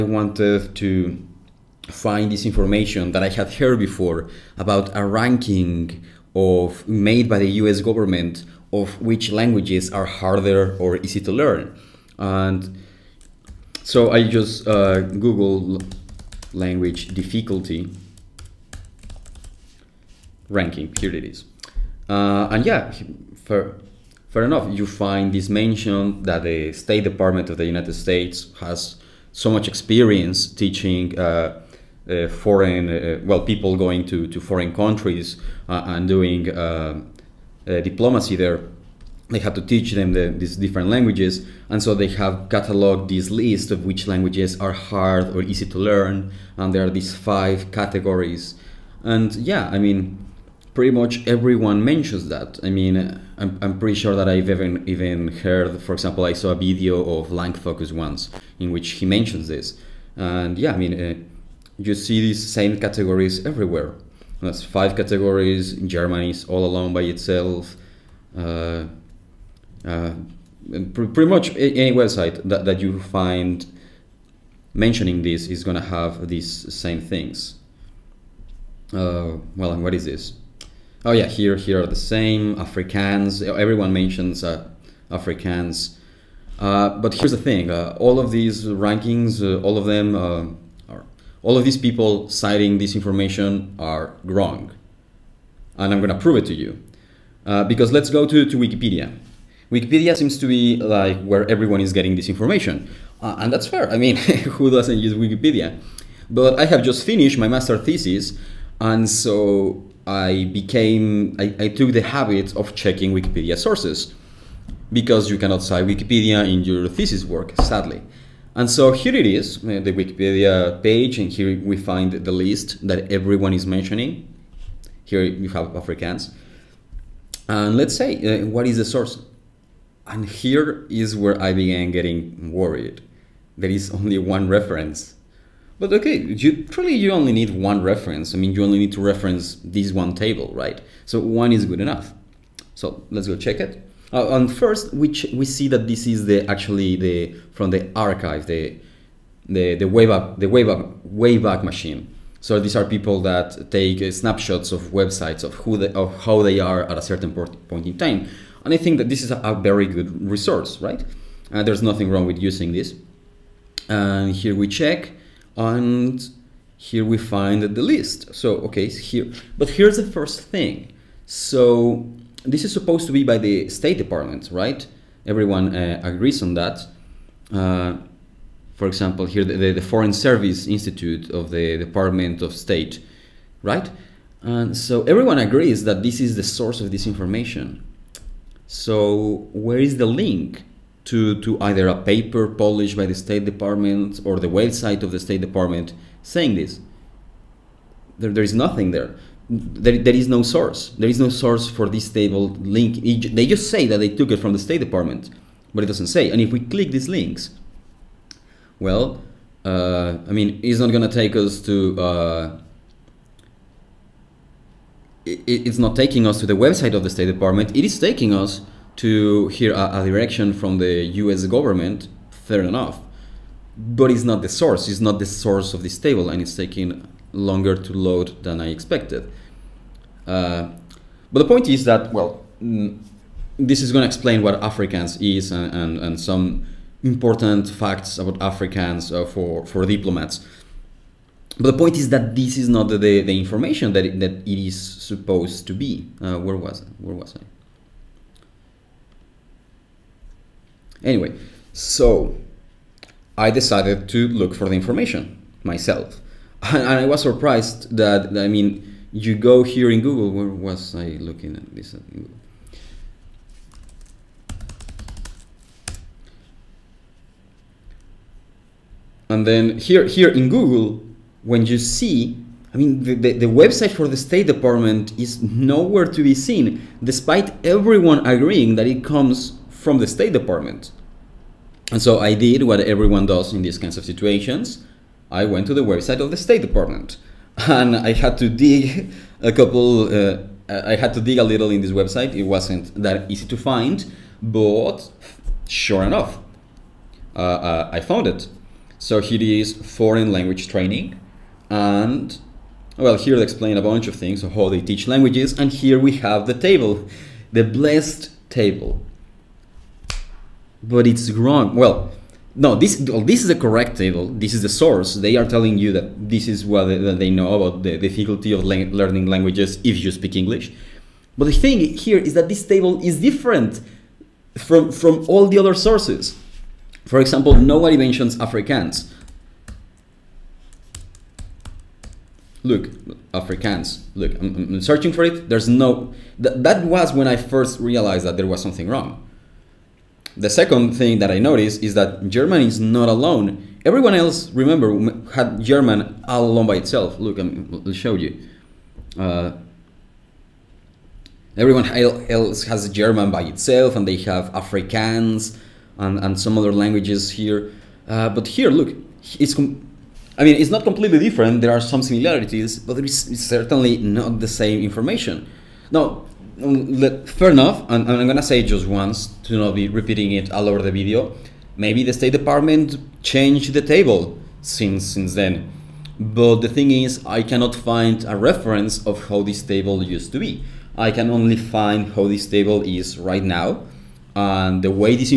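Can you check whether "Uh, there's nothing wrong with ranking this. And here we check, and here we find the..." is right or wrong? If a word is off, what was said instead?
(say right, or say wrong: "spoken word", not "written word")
wrong: "using", not "ranking".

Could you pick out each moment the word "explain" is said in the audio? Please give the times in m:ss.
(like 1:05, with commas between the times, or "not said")
3:54, 5:03.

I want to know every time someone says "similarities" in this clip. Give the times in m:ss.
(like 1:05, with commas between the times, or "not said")
6:02.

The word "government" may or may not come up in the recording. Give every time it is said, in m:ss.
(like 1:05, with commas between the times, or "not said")
0:07, 3:41.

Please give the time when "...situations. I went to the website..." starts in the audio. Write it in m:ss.
4:44.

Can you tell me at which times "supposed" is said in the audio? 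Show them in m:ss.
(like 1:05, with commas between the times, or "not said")
2:52, 4:04.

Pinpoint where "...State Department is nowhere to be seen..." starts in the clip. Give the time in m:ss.
4:34.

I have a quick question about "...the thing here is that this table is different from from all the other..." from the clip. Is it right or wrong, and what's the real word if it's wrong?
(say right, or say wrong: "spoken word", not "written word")
right.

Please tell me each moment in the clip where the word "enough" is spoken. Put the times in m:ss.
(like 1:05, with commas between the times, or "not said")
0:24, 2:21, 3:42, 4:56, 6:07.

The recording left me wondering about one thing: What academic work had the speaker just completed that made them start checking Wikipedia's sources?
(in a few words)
master thesis.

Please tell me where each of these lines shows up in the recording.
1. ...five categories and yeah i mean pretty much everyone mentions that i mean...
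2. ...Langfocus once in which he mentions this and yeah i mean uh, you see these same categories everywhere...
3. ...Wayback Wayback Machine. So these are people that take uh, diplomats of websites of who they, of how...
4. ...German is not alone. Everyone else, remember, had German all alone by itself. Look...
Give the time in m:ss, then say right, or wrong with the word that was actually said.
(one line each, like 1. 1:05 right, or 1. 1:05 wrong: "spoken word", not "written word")
1. 0:47 right
2. 0:57 right
3. 2:30 wrong: "snapshots", not "diplomats"
4. 5:42 right.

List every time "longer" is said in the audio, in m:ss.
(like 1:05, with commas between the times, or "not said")
3:47.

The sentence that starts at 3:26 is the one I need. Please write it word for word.
And if we click these links, well, uh, I mean, it's not gonna take us to.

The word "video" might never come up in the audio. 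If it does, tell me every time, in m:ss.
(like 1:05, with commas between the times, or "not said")
0:56, 6:10.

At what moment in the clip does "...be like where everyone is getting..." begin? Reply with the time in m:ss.
1:40.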